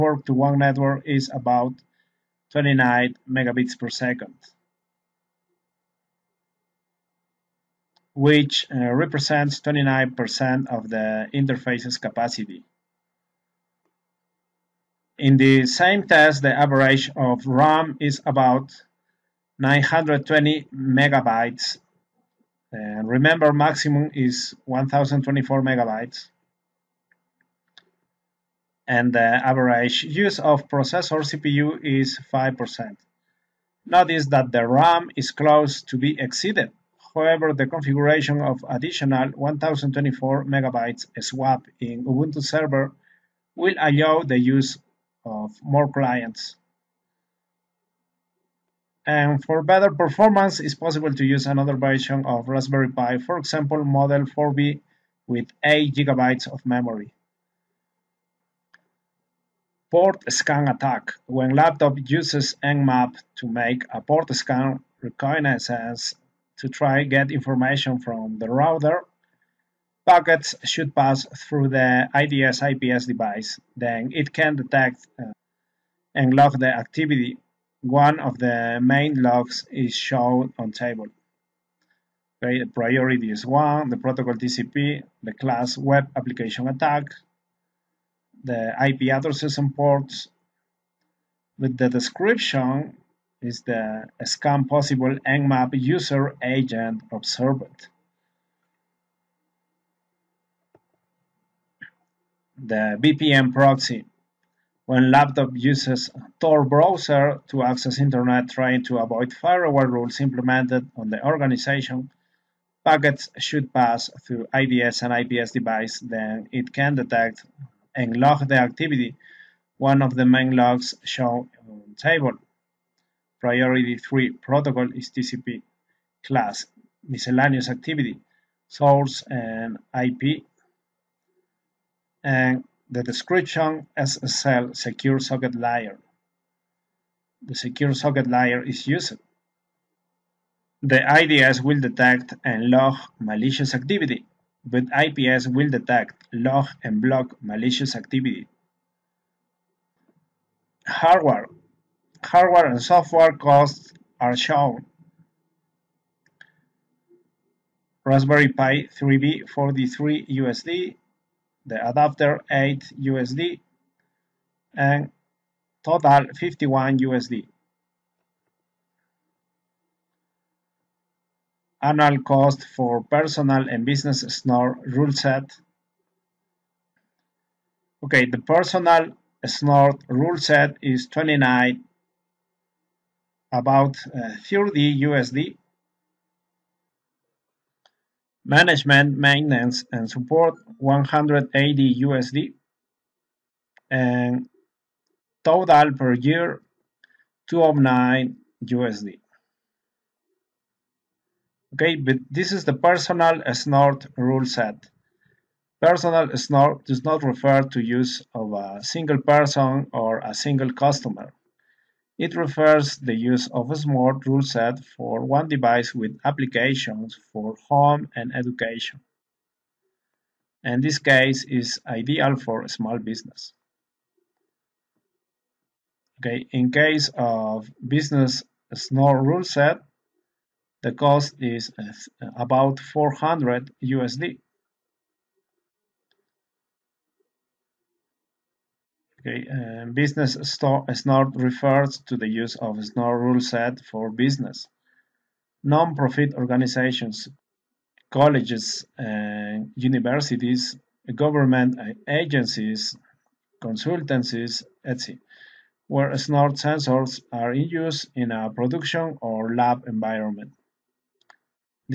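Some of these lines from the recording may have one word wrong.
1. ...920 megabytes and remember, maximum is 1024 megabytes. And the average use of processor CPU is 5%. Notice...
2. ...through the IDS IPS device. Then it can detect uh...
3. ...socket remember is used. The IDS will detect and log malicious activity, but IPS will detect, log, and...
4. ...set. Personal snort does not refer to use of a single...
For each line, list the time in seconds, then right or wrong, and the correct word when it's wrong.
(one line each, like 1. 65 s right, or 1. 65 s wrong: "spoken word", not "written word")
1. 19 s right
2. 71 s right
3. 137 s wrong: "layer", not "remember"
4. 204 s right.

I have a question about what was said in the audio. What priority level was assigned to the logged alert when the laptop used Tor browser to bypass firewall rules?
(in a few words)
3.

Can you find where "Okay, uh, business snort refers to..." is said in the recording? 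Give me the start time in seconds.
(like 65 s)
239 s.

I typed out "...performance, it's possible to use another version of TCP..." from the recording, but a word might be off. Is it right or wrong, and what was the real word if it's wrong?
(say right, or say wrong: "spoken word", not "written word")
wrong: "Raspberry", not "TCP".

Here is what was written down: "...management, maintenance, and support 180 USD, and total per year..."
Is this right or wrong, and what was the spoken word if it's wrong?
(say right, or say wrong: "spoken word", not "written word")
right.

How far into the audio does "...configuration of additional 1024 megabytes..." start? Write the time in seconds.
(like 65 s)
37 s.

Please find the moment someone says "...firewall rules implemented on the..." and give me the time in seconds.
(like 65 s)
109 s.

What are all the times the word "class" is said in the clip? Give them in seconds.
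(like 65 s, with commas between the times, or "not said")
85 s, 126 s.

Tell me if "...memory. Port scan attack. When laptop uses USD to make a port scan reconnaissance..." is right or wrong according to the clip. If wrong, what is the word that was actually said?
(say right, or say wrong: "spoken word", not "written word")
wrong: "Nmap", not "USD".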